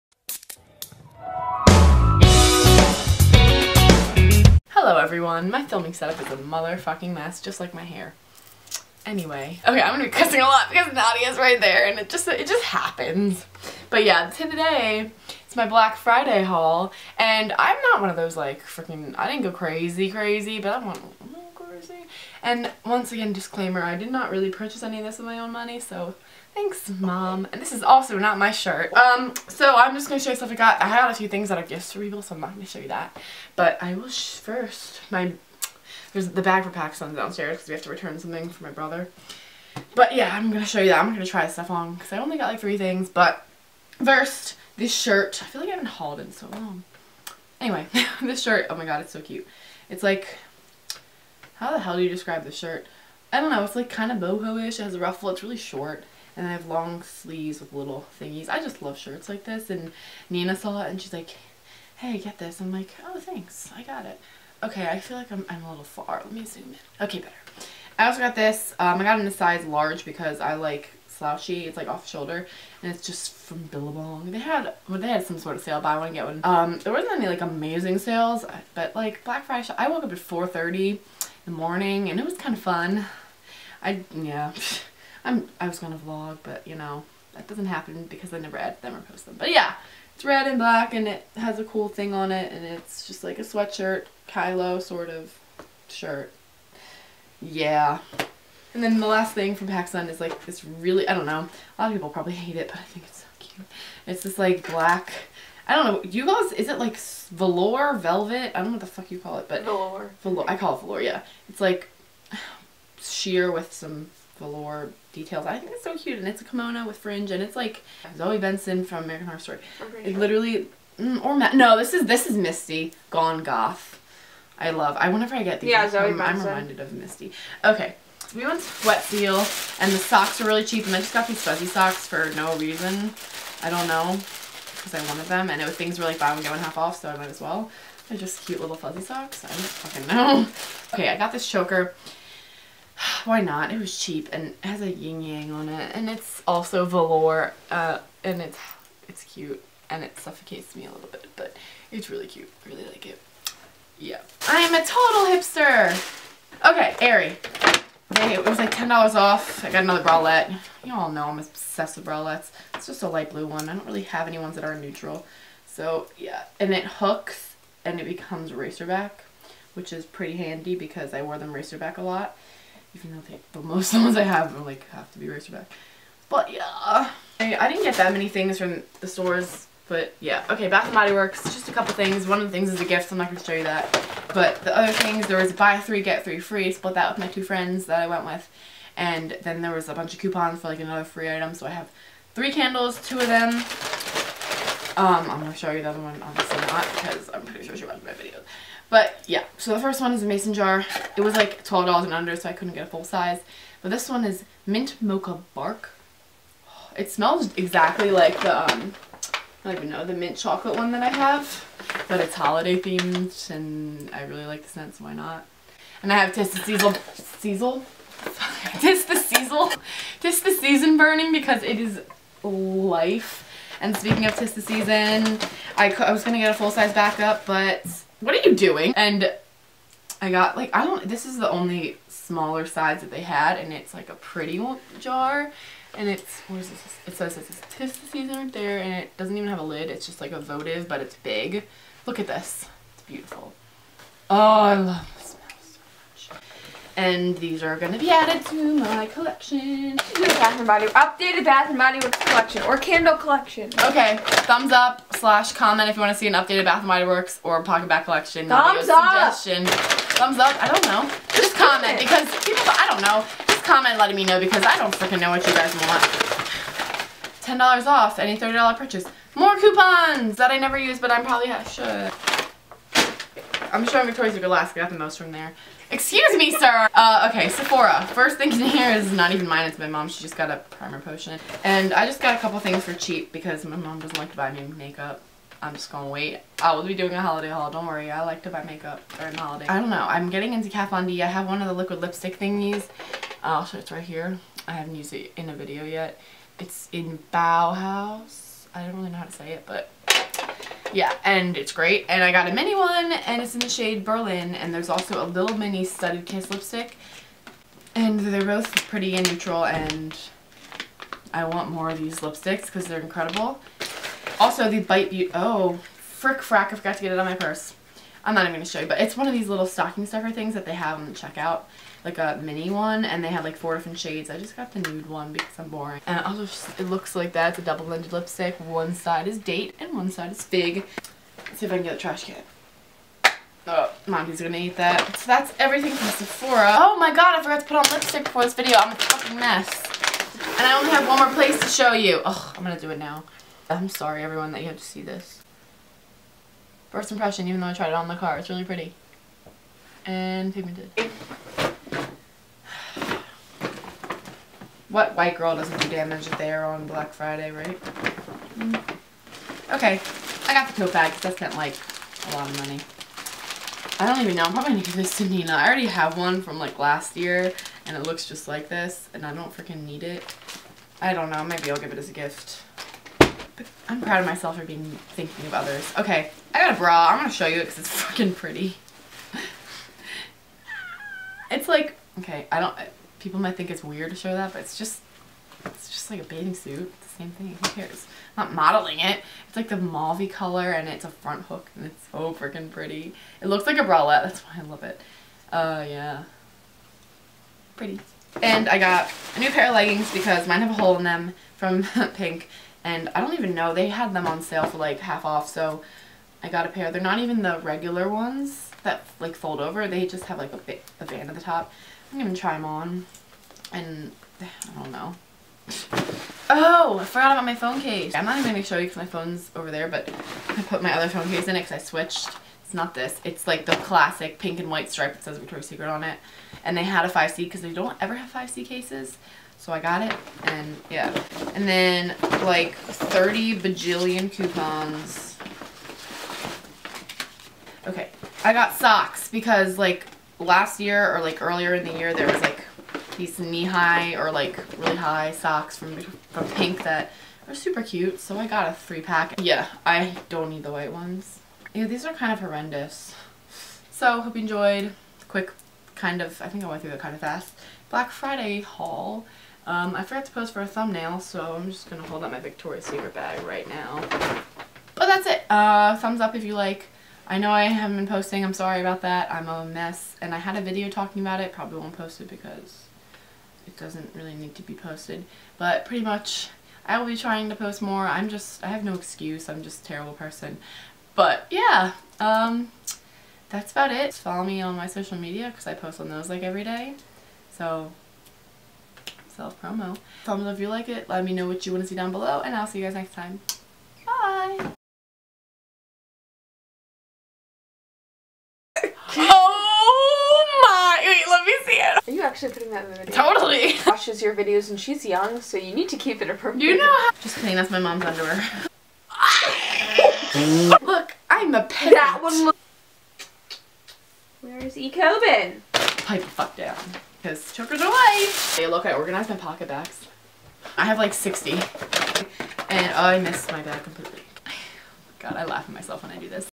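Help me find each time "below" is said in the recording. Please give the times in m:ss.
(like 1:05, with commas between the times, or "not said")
8:12.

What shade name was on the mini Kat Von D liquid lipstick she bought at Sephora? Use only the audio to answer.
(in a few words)
Berlin.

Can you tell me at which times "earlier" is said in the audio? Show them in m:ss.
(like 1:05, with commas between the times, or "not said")
7:21.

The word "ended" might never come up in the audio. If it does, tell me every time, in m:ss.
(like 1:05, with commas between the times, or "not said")
5:27.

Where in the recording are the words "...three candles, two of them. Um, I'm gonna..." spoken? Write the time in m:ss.
3:12.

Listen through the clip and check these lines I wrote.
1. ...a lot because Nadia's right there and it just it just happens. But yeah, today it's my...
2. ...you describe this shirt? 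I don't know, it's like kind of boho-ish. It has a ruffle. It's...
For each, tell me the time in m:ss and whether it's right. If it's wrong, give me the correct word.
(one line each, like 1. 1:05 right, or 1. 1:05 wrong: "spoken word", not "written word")
1. 0:10 right
2. 0:52 right.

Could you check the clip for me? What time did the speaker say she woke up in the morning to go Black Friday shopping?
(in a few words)
4:30.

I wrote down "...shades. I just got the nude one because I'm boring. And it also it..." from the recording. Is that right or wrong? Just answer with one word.
right.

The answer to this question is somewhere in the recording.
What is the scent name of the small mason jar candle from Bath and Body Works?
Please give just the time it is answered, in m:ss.
3:24.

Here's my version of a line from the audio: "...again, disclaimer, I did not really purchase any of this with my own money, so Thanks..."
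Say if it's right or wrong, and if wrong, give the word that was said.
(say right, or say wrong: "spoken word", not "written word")
right.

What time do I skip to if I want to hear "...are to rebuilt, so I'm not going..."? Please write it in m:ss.
0:31.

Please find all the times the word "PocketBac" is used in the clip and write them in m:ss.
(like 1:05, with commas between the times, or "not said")
4:17, 8:39.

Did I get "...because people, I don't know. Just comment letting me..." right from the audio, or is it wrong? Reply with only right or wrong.
right.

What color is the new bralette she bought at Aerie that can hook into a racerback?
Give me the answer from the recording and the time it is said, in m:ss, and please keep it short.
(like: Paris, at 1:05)
light blue, at 2:43.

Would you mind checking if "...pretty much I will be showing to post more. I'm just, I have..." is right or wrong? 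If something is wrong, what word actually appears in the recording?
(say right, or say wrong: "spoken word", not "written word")
wrong: "trying", not "showing".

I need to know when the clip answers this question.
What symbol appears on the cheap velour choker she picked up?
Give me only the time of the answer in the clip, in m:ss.
2:24.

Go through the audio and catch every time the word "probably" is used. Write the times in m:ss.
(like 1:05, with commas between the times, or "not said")
1:42, 4:31, 6:04, 7:51.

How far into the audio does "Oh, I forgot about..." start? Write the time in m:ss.
6:56.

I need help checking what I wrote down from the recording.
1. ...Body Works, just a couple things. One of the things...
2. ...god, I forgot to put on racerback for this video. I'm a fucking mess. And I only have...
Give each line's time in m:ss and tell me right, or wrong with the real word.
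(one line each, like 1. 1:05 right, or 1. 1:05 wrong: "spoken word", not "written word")
1. 3:00 right
2. 5:37 wrong: "lipstick", not "racerback".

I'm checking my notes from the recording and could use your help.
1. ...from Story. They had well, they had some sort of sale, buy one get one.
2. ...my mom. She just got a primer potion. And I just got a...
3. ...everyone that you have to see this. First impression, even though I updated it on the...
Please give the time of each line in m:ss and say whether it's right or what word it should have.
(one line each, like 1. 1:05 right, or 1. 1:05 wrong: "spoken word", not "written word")
1. 1:13 wrong: "Billabong", not "Story"
2. 4:39 right
3. 5:44 wrong: "tried", not "updated".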